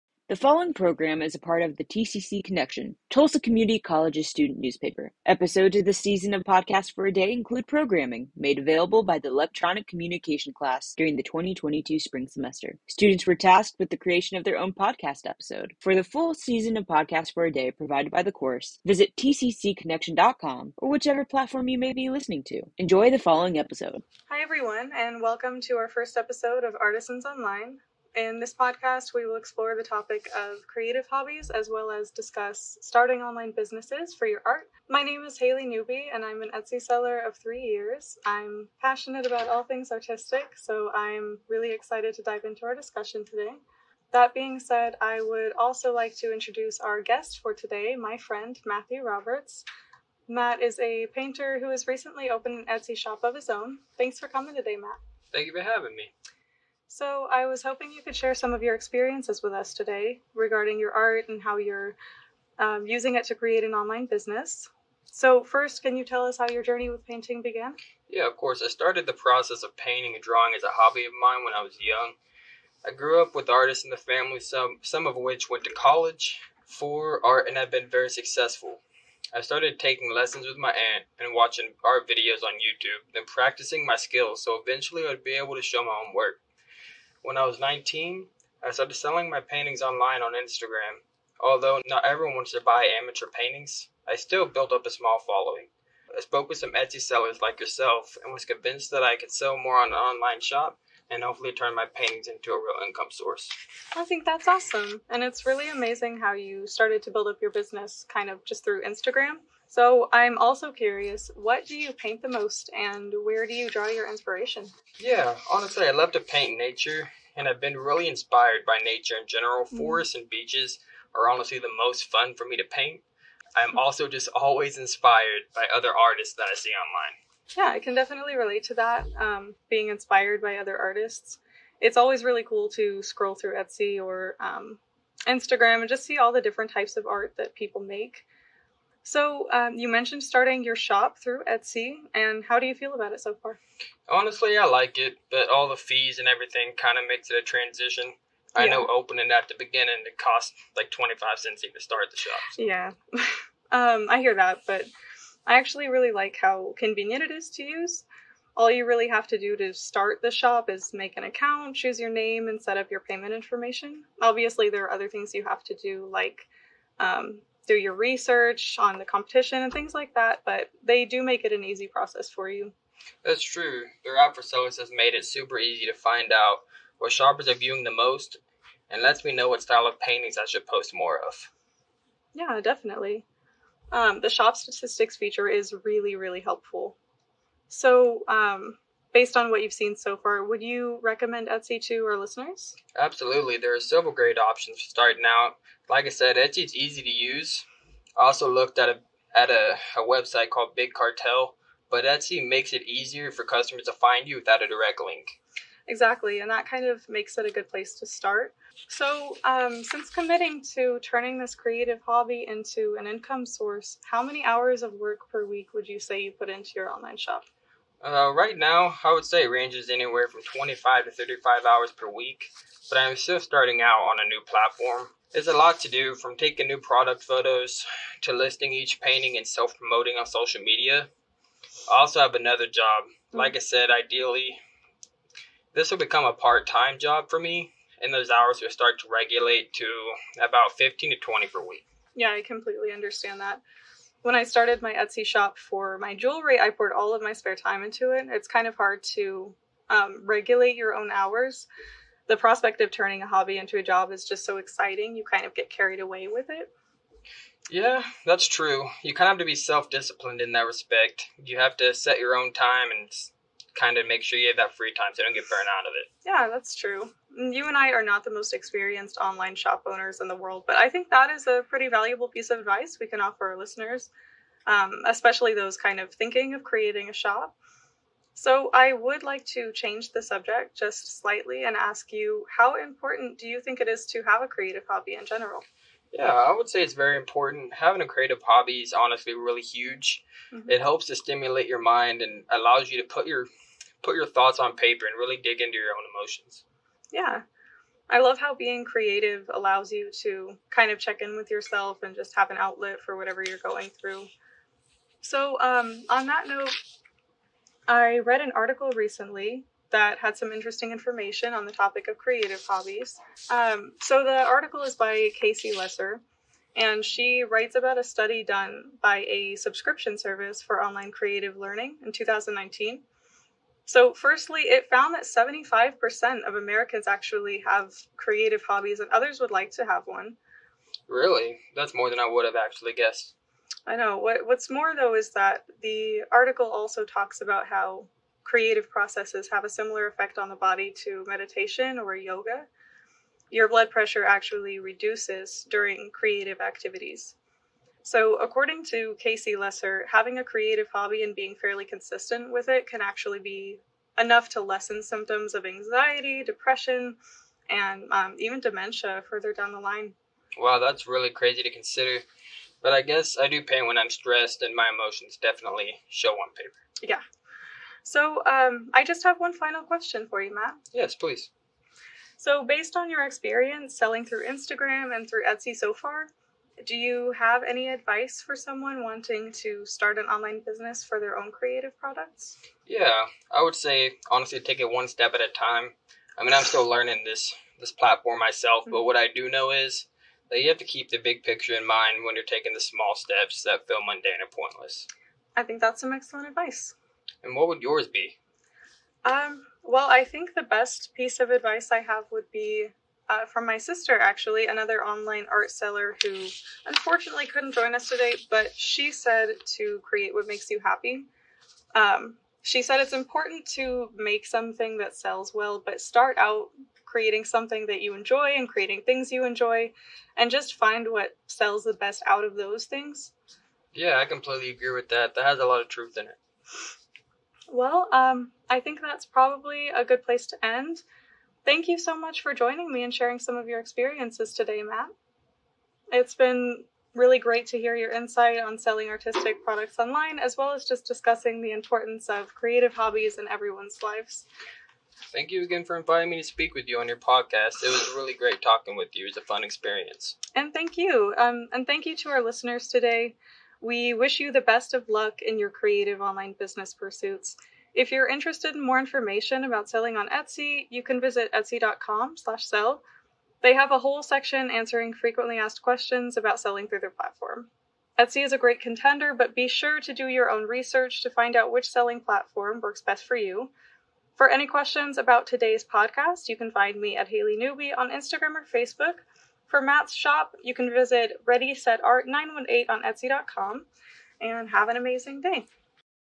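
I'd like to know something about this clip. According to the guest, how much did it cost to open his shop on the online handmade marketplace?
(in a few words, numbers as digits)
25 cents.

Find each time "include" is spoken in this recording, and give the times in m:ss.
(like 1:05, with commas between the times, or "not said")
0:07.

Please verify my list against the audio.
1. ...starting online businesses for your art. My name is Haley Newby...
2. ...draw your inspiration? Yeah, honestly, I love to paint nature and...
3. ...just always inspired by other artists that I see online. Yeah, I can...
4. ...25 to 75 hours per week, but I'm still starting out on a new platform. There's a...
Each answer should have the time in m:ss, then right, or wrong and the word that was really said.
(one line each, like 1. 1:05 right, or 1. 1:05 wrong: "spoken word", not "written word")
1. 0:32 right
2. 1:53 right
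3. 2:04 right
4. 3:40 wrong: "35", not "75".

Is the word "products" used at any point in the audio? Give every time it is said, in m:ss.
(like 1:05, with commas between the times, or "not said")
3:46, 6:21, 7:19.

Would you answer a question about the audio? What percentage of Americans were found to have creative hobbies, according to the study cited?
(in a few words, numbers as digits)
75%.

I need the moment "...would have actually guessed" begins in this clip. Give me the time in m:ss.
5:32.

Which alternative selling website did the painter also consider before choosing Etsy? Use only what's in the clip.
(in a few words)
Big Cartel.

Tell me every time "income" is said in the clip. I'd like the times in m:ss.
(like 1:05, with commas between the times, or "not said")
1:42, 3:33.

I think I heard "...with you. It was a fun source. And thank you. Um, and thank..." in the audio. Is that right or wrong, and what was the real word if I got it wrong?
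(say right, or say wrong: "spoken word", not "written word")
wrong: "experience", not "source".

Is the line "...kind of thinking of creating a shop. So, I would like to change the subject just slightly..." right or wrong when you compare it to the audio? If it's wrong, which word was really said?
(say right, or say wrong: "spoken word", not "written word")
right.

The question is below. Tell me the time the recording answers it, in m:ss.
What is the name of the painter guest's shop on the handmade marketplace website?
8:01.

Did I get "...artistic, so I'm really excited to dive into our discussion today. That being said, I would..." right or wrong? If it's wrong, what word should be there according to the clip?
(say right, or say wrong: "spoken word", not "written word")
right.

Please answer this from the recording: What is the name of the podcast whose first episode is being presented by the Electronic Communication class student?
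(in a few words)
Artisans Online.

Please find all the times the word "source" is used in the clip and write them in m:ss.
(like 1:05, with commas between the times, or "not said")
1:43, 3:33.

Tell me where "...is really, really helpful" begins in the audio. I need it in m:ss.
3:05.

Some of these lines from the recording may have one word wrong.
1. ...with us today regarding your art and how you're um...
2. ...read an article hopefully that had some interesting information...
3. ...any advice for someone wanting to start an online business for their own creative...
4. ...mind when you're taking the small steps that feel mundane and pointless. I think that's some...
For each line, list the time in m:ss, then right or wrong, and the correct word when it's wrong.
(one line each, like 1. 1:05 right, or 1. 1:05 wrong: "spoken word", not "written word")
1. 0:59 right
2. 5:08 wrong: "recently", not "hopefully"
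3. 6:17 right
4. 6:31 right.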